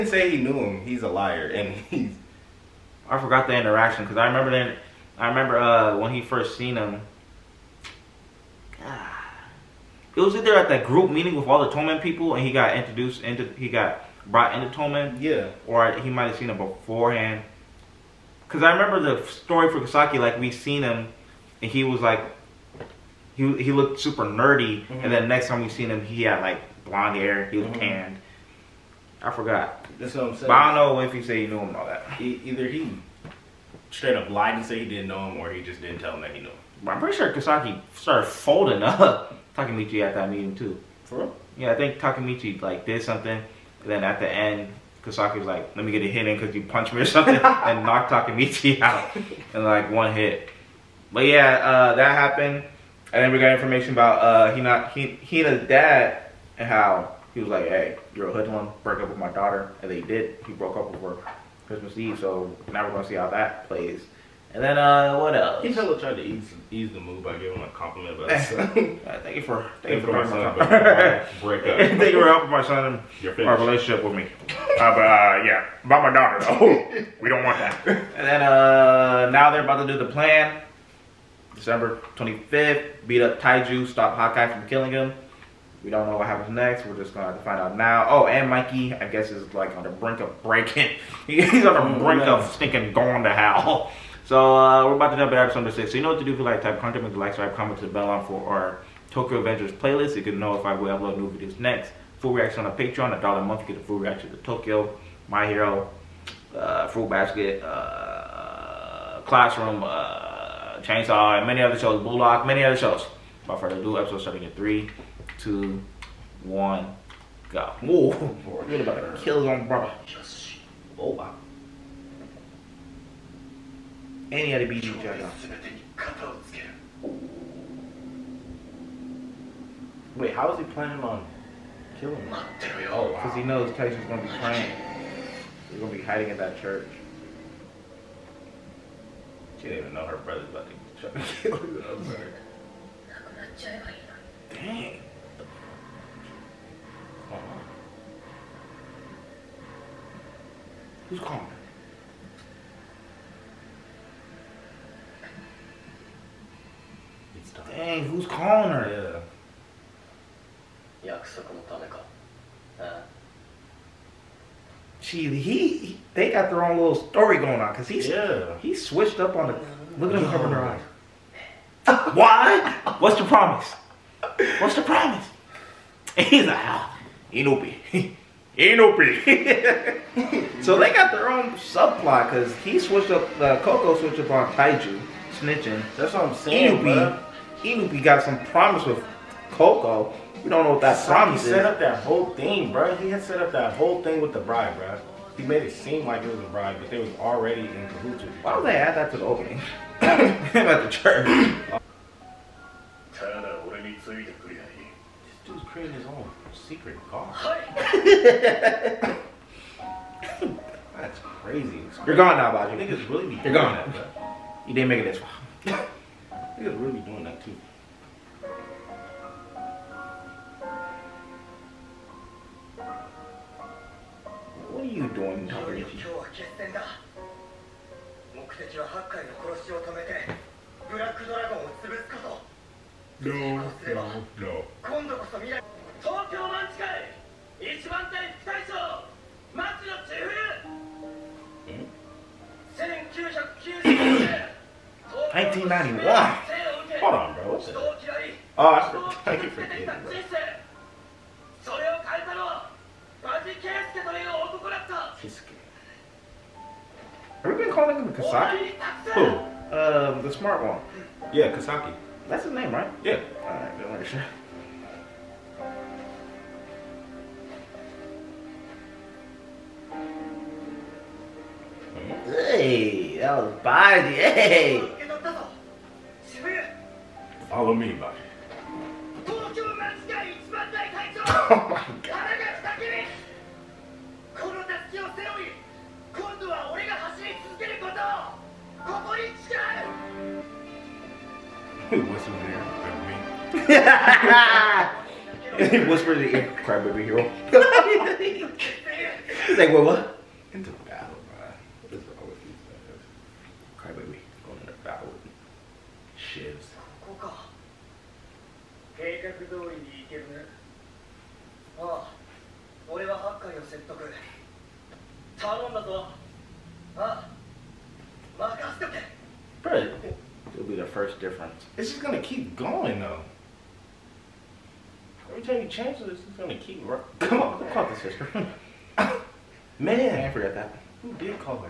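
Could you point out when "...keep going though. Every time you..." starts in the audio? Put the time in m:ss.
5:22.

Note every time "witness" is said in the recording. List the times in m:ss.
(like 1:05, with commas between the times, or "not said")
not said.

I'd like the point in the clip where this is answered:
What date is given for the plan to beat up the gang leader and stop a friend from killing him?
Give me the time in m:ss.
1:21.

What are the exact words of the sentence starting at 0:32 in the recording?
He, either he straight up lied and said he didn't know him, or he just didn't tell him that he knew him.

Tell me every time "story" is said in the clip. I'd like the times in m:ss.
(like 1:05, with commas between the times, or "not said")
0:19, 2:46.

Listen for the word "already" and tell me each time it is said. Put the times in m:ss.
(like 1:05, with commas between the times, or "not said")
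3:17.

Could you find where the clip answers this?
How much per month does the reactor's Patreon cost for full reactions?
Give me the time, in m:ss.
1:43.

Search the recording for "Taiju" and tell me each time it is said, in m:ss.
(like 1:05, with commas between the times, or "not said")
1:23, 2:13, 3:04.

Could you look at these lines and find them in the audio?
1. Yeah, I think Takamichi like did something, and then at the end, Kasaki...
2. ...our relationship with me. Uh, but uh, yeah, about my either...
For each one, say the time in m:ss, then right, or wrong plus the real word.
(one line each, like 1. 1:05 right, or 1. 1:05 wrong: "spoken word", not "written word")
1. 0:41 right
2. 1:13 wrong: "daughter", not "either".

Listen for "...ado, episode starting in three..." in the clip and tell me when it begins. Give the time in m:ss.
1:53.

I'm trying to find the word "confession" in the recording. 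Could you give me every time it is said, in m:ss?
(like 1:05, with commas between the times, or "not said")
not said.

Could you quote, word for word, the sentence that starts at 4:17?
Have we been calling him Kasaki?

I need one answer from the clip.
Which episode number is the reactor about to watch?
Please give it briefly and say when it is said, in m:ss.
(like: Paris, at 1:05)
6, at 1:35.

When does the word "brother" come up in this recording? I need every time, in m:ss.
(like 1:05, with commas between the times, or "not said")
1:59, 2:20.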